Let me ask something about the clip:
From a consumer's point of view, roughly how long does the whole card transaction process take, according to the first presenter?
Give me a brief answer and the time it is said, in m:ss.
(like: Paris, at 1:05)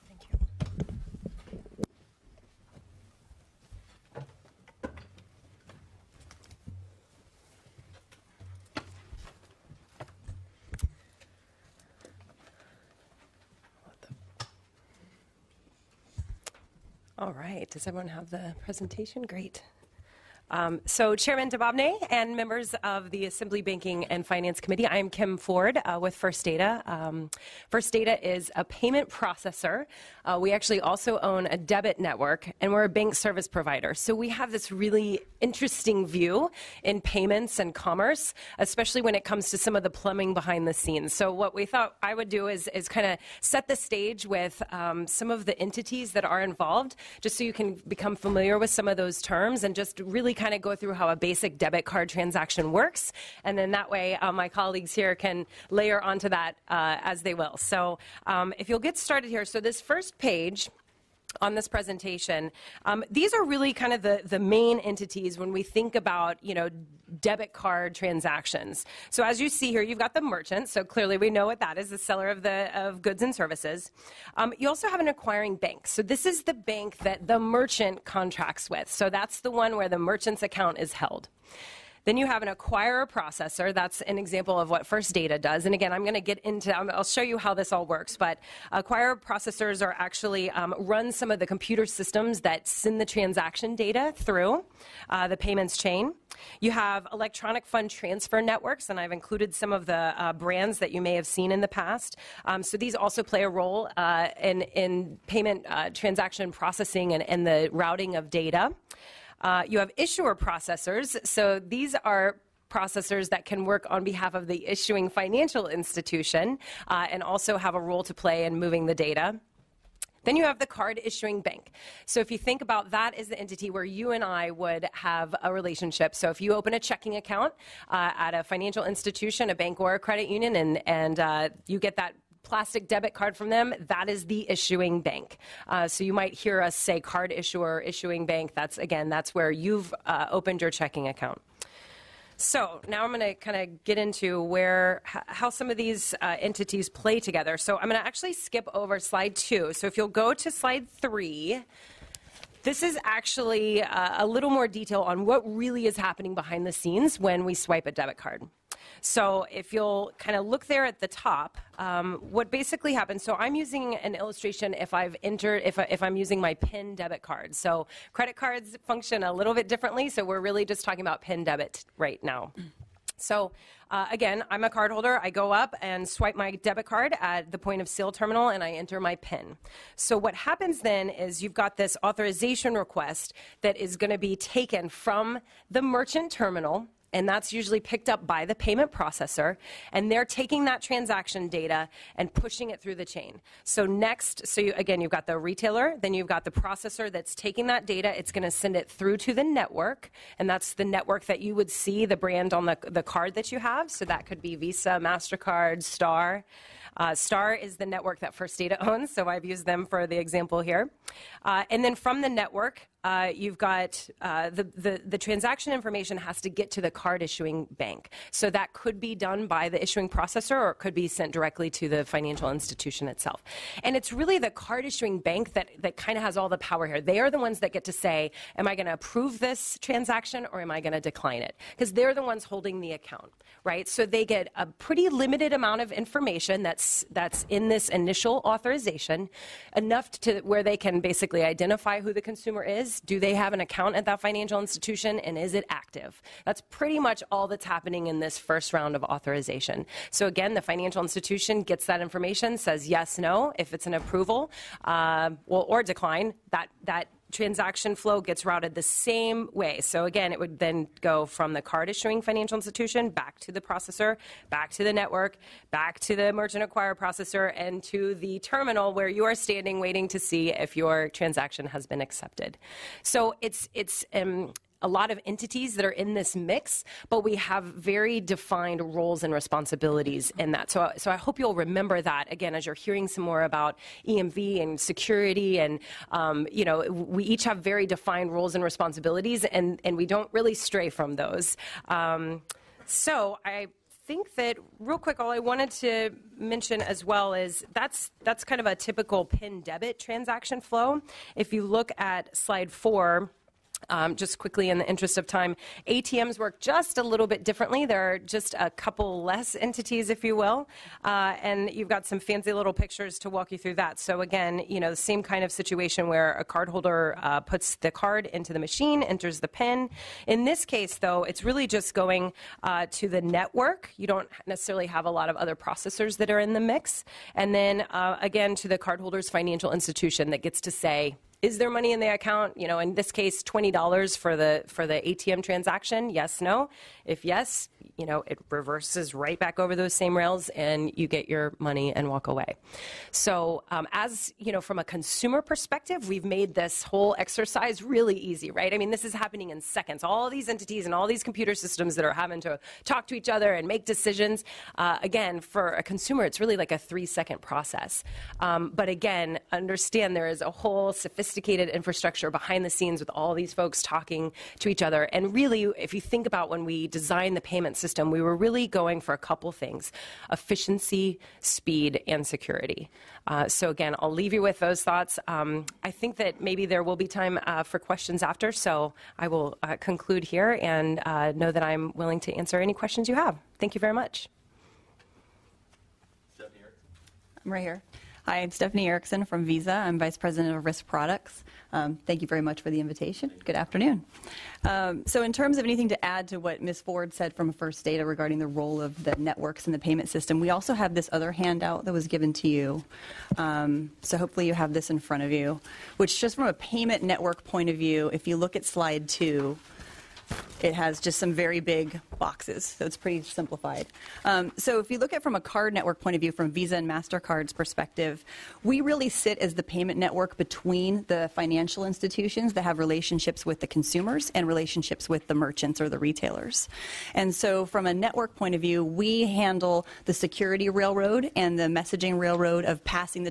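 3 seconds, at 5:56.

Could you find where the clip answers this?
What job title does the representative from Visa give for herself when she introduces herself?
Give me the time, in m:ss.
6:29.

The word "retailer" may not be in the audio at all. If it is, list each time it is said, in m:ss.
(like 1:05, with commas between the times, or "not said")
3:15, 7:05.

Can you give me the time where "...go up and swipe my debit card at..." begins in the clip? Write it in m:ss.
2:55.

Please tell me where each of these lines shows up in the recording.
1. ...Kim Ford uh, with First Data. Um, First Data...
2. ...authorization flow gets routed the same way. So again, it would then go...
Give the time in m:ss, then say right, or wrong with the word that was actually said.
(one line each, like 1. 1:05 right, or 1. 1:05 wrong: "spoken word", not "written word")
1. 0:25 right
2. 4:17 wrong: "transaction", not "authorization".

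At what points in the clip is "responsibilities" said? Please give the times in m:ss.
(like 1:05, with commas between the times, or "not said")
4:39, 4:48.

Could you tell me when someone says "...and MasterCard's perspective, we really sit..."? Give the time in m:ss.
6:56.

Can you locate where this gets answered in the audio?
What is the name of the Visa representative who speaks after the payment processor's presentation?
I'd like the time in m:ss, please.
6:28.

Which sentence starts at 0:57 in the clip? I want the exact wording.
So um, if you'll get started here, so this first page on this presentation.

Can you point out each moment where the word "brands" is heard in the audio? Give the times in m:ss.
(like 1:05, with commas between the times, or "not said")
1:40, 3:22.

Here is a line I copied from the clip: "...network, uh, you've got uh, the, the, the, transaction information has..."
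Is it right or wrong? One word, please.
right.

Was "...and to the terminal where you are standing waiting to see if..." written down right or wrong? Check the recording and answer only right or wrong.
right.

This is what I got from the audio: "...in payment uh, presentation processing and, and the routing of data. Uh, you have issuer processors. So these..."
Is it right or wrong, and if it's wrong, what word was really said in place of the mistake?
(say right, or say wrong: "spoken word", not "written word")
wrong: "transaction", not "presentation".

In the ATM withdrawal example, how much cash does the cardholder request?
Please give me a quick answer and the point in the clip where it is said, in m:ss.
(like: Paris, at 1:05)
$20, at 5:33.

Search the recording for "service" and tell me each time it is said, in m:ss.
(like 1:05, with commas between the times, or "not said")
0:33, 1:13.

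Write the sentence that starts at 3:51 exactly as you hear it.
Because they're the ones holding the account, right?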